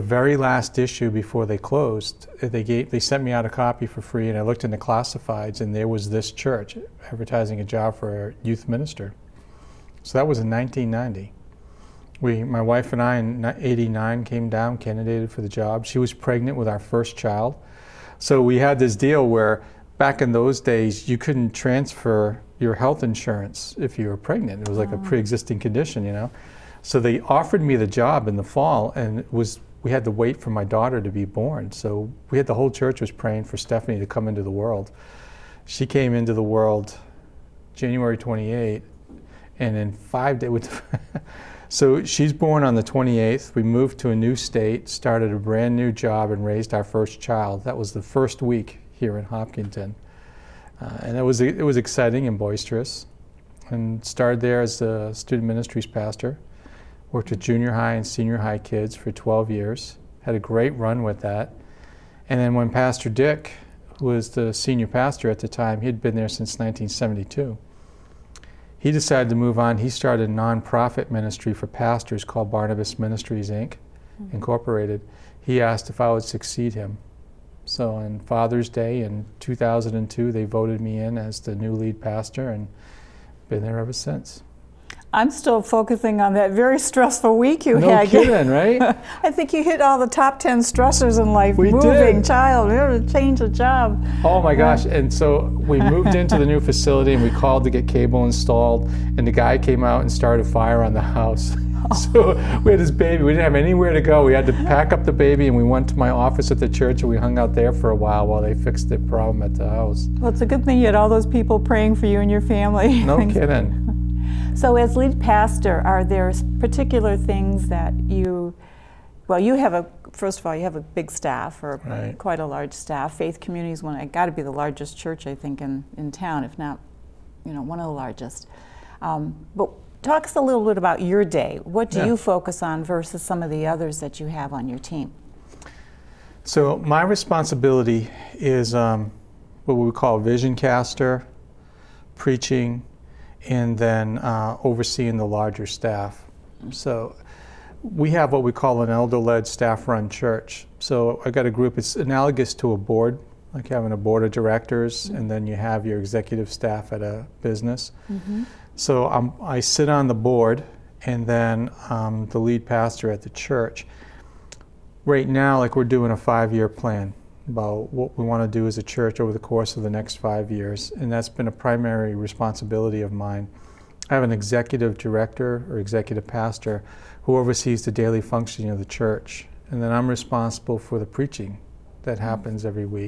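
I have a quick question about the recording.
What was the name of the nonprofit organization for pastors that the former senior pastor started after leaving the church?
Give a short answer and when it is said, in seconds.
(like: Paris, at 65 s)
Barnabas Ministries, at 72 s.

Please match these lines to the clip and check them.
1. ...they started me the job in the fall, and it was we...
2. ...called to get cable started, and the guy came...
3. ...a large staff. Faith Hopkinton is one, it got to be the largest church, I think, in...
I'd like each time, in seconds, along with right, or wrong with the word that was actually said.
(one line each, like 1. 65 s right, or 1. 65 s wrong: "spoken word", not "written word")
1. 27 s wrong: "offered", not "started"
2. 97 s wrong: "installed", not "started"
3. 122 s wrong: "Community", not "Hopkinton".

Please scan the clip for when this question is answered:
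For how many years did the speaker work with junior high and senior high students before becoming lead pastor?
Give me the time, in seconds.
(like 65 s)
59 s.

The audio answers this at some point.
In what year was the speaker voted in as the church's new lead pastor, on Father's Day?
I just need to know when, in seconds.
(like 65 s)
79 s.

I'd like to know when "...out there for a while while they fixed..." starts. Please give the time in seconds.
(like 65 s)
107 s.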